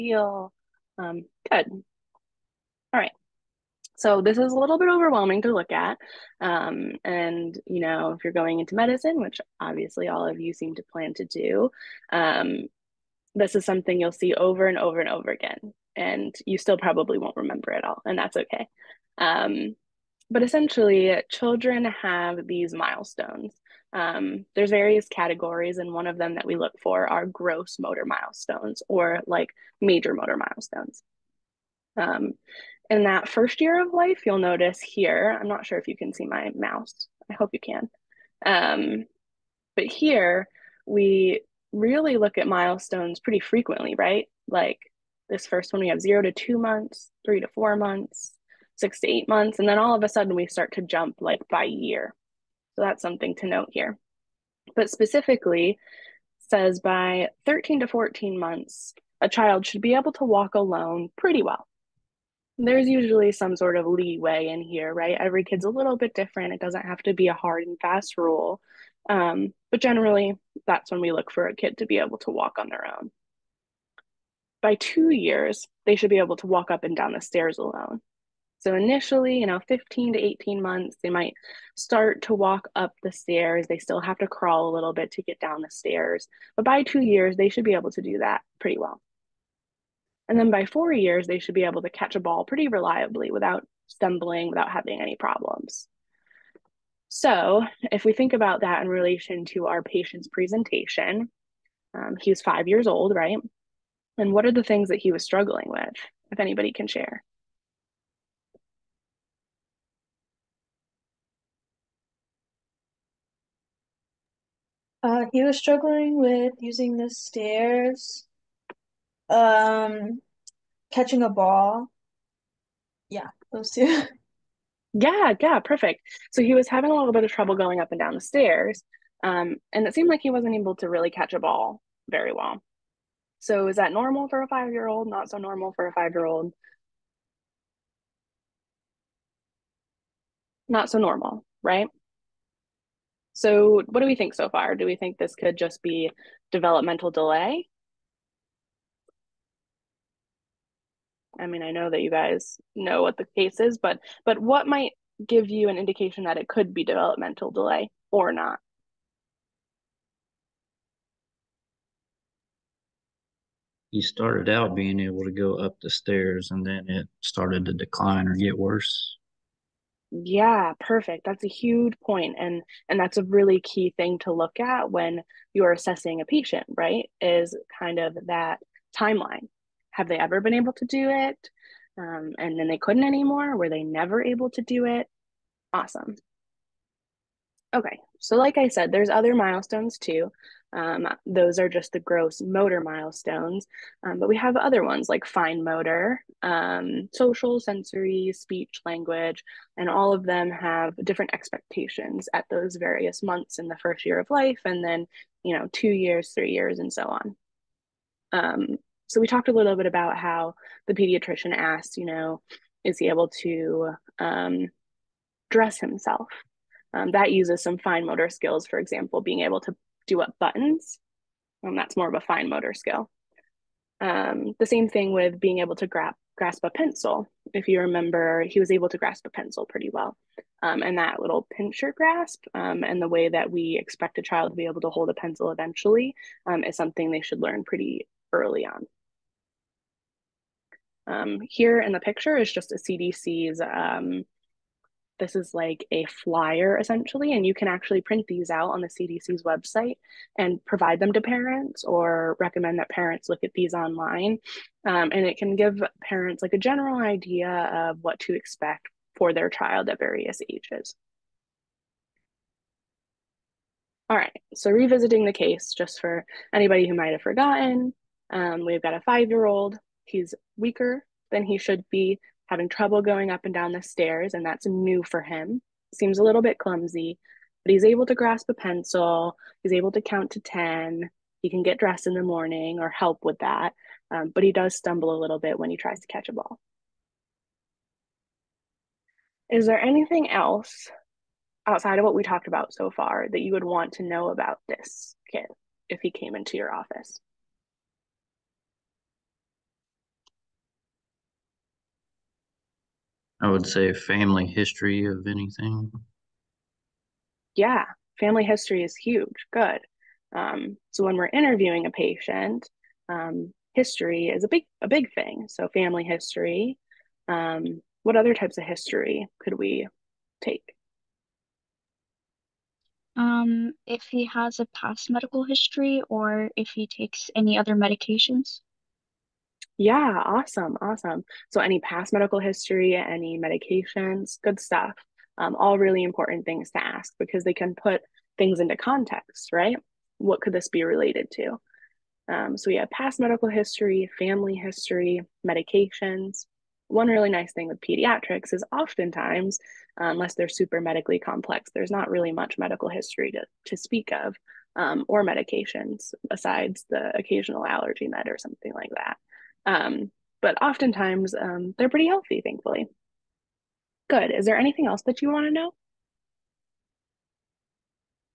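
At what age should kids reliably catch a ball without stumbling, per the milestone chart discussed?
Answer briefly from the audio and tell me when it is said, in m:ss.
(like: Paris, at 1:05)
4 years, at 1:30.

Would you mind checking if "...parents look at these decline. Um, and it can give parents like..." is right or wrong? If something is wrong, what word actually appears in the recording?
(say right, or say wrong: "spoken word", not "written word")
wrong: "online", not "decline".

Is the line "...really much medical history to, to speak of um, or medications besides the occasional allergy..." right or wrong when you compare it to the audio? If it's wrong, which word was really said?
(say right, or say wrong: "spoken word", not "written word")
right.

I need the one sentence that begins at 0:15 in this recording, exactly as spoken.
And you still probably won't remember it all, and that's okay.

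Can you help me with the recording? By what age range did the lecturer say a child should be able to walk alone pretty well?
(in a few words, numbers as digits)
13 to 14 months.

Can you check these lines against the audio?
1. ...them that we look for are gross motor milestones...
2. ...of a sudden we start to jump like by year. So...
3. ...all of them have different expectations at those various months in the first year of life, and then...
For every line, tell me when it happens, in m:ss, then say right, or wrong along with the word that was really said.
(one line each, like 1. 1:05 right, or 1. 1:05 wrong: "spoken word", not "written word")
1. 0:26 right
2. 0:49 right
3. 3:19 right.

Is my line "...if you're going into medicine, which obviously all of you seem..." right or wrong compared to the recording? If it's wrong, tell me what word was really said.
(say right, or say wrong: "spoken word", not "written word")
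right.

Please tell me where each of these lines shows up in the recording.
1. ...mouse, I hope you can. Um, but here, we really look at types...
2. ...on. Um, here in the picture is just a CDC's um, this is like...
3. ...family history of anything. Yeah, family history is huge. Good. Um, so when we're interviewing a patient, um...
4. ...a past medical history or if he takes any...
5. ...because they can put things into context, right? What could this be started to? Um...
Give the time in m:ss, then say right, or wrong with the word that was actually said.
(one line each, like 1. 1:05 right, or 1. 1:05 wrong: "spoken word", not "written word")
1. 0:36 wrong: "milestones", not "types"
2. 3:58 right
3. 5:03 right
4. 5:24 right
5. 5:37 wrong: "related", not "started".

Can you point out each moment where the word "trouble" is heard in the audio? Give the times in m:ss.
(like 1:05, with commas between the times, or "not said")
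2:07, 4:32.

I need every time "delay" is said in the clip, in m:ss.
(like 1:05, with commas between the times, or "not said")
2:27, 2:37.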